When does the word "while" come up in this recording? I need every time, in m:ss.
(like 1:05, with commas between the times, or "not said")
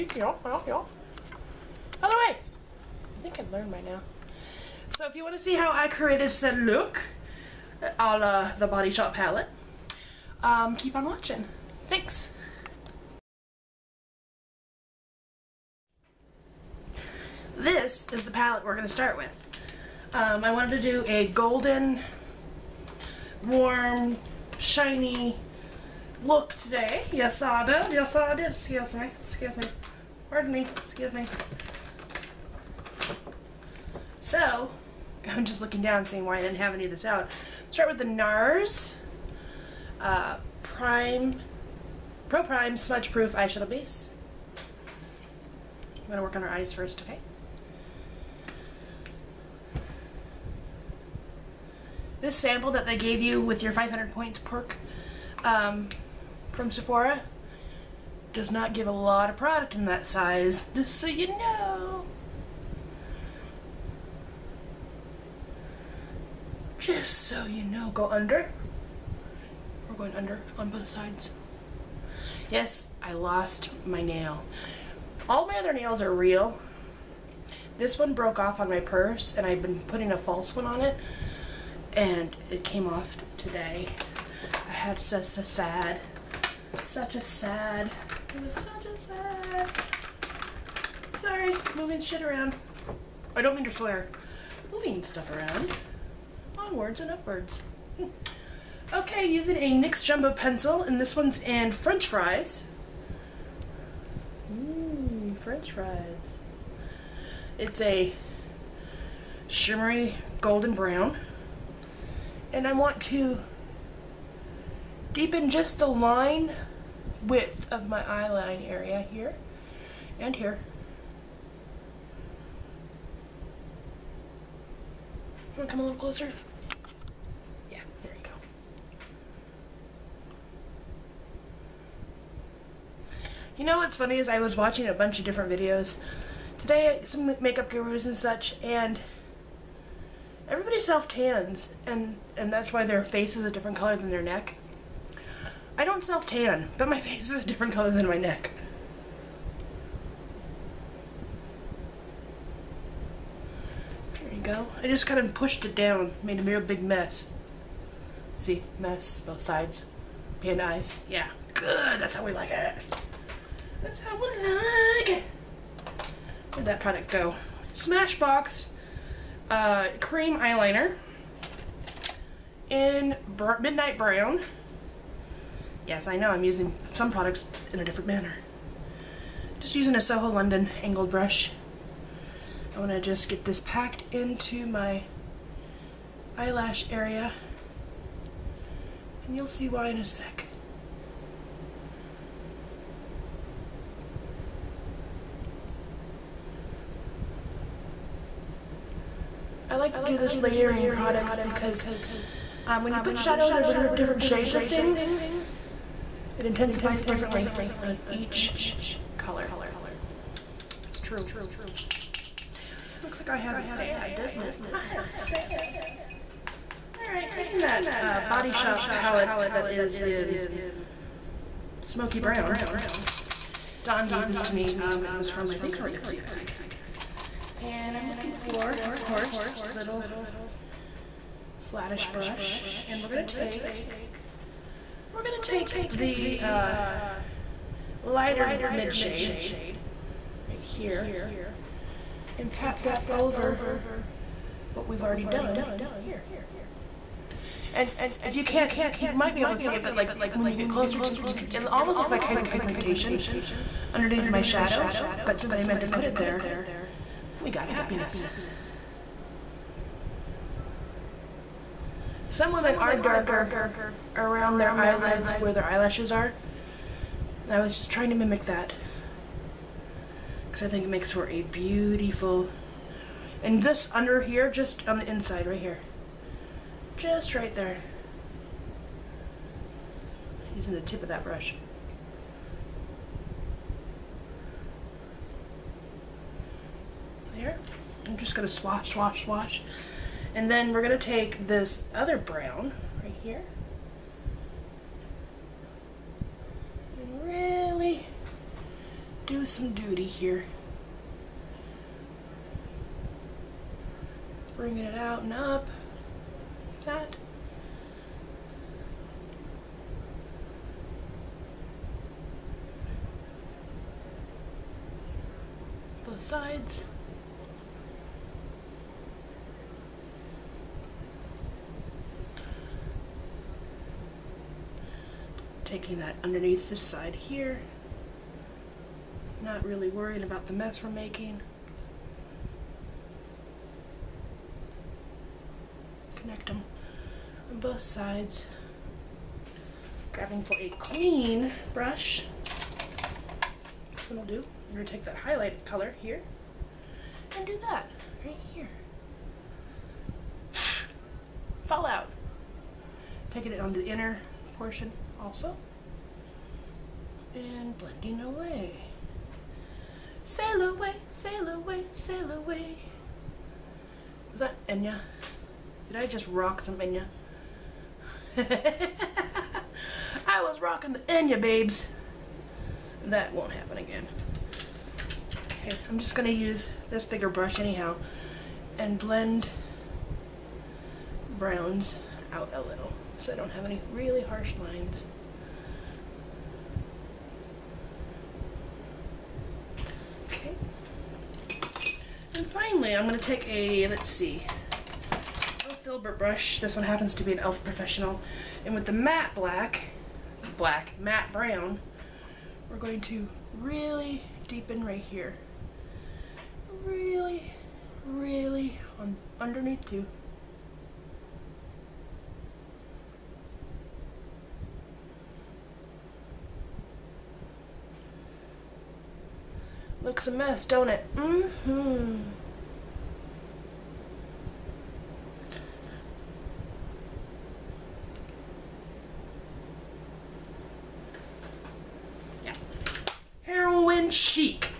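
not said.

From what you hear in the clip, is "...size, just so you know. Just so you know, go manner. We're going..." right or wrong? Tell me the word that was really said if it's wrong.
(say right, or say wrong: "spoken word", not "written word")
wrong: "under", not "manner".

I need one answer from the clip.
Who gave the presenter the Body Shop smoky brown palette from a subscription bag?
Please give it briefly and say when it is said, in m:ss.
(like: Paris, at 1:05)
Dawn, at 3:43.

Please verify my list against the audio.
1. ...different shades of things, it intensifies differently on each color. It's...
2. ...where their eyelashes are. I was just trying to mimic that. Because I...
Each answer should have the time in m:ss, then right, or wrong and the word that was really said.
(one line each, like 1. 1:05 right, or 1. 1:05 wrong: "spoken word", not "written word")
1. 3:23 right
2. 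4:25 right.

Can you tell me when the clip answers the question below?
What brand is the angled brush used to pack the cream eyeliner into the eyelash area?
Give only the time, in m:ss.
3:00.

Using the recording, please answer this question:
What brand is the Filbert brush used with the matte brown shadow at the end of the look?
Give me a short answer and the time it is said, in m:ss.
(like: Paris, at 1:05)
Elf Professional, at 6:37.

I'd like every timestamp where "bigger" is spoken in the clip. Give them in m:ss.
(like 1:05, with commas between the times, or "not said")
6:17.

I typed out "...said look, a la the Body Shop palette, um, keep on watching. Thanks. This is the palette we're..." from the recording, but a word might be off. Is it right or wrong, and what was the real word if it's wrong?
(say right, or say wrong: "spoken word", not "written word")
right.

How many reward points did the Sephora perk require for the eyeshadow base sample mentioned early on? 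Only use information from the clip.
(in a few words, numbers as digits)
500.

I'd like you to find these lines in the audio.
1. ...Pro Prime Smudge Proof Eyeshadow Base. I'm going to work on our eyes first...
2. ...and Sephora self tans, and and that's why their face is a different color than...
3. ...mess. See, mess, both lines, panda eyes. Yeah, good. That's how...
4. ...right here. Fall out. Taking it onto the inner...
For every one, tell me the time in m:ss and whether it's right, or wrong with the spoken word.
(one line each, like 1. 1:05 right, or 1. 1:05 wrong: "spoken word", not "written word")
1. 0:42 right
2. 2:18 wrong: "Everybody", not "Sephora"
3. 2:36 wrong: "sides", not "lines"
4. 5:48 right.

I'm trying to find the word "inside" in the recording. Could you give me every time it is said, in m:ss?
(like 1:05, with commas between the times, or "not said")
4:35.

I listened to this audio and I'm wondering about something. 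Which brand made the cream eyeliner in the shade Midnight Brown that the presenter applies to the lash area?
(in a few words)
Smashbox.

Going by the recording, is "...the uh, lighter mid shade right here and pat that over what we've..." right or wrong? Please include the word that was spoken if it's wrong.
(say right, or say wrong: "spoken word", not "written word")
right.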